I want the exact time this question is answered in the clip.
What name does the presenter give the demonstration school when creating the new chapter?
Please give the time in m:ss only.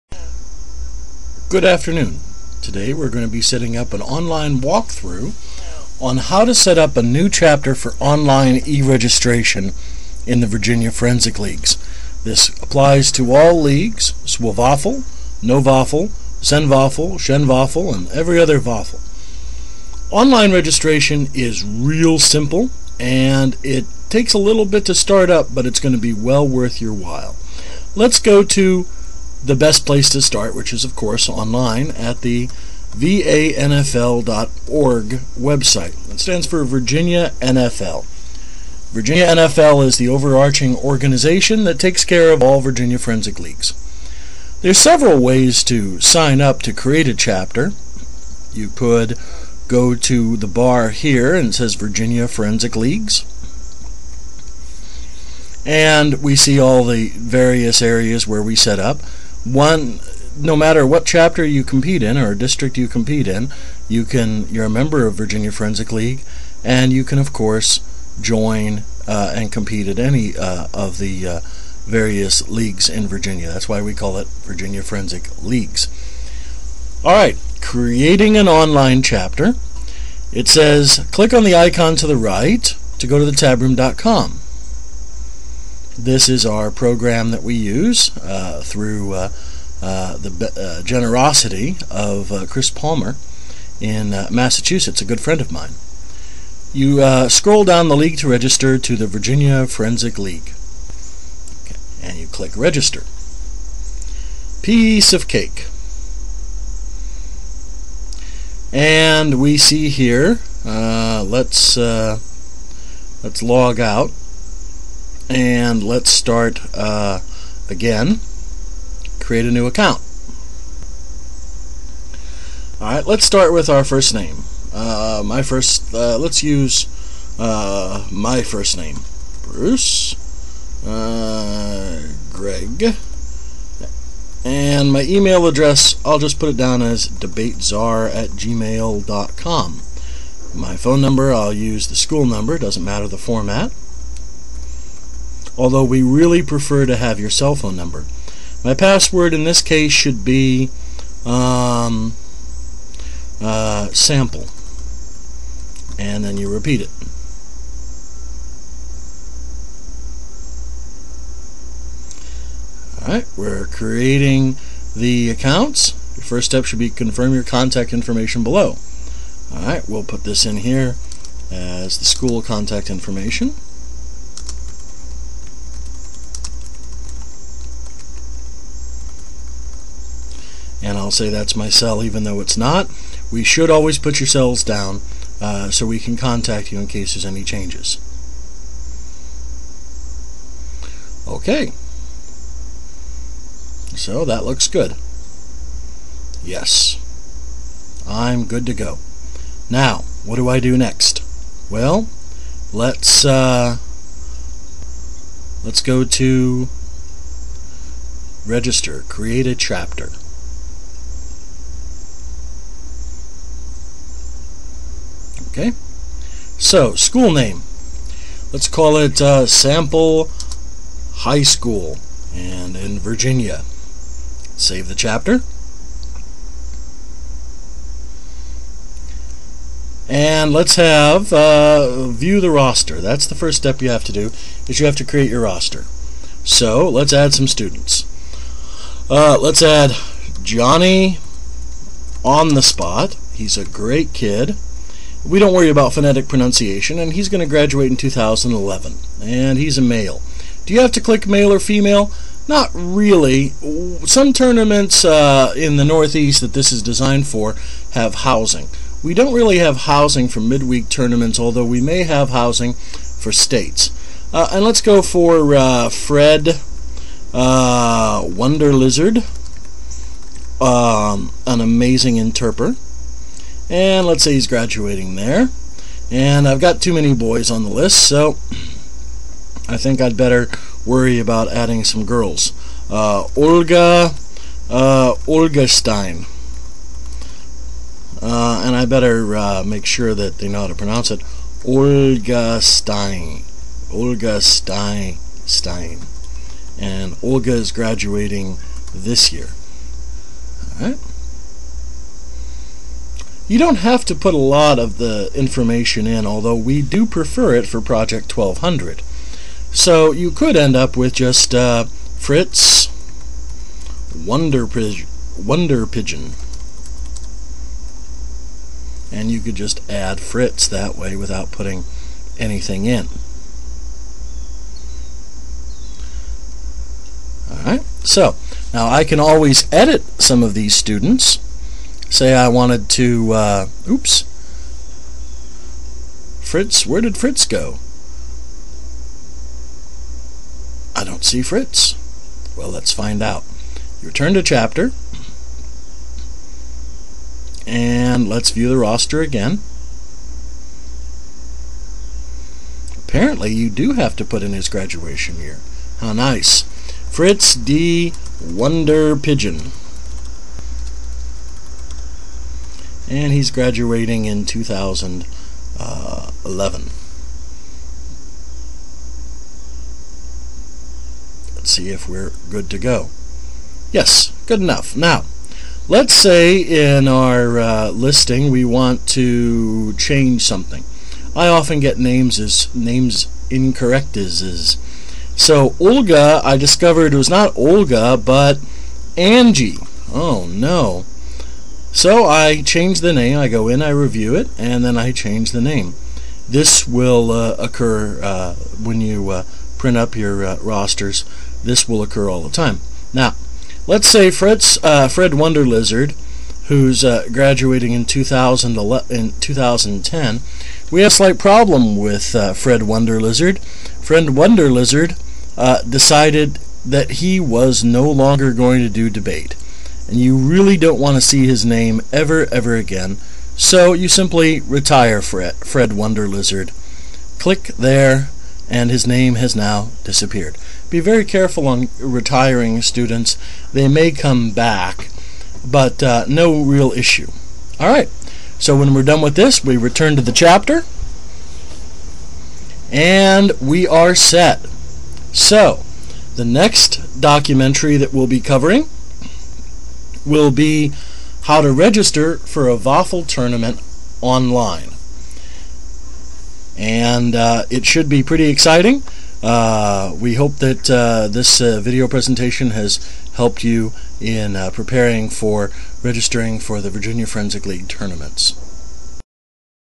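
3:39.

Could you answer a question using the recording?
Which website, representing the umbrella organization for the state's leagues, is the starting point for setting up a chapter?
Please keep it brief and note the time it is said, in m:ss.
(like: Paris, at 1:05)
vanfl.org, at 0:32.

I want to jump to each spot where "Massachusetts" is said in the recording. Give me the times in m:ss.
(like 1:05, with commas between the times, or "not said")
1:34.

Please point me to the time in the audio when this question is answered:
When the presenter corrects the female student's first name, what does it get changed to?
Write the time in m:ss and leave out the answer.
6:29.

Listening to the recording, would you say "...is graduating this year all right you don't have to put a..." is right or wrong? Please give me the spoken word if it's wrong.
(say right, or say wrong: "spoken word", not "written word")
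right.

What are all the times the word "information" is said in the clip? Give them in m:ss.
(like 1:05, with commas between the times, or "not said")
2:47, 2:52, 5:05.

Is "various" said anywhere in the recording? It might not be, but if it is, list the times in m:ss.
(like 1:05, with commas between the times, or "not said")
0:57, 1:11.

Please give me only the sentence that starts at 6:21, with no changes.
I often get names as names incorrect as is.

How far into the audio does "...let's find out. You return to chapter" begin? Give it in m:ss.
5:42.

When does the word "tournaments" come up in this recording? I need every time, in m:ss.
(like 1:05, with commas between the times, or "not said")
4:14, 4:20, 7:33, 7:47.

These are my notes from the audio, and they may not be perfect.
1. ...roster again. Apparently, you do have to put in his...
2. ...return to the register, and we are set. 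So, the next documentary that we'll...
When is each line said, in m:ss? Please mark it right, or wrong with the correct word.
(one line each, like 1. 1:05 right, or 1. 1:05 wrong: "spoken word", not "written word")
1. 5:48 right
2. 7:19 wrong: "chapter", not "register".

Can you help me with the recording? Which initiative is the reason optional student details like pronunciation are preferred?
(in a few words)
Project 1200.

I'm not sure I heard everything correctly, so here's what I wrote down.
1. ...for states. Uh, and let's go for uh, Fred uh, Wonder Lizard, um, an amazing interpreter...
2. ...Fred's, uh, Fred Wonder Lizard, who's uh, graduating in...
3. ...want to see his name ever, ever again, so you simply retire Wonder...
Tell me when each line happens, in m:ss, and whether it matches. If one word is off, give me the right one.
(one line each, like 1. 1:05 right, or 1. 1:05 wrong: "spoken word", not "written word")
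1. 4:22 right
2. 6:44 right
3. 7:00 wrong: "Fred", not "Wonder".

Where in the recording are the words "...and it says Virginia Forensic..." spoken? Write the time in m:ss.
0:51.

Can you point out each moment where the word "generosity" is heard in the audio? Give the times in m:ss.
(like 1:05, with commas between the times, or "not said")
1:30.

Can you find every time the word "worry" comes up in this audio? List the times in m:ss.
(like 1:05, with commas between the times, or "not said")
4:05, 4:40.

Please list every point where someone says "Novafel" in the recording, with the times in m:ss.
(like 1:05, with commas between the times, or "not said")
0:15.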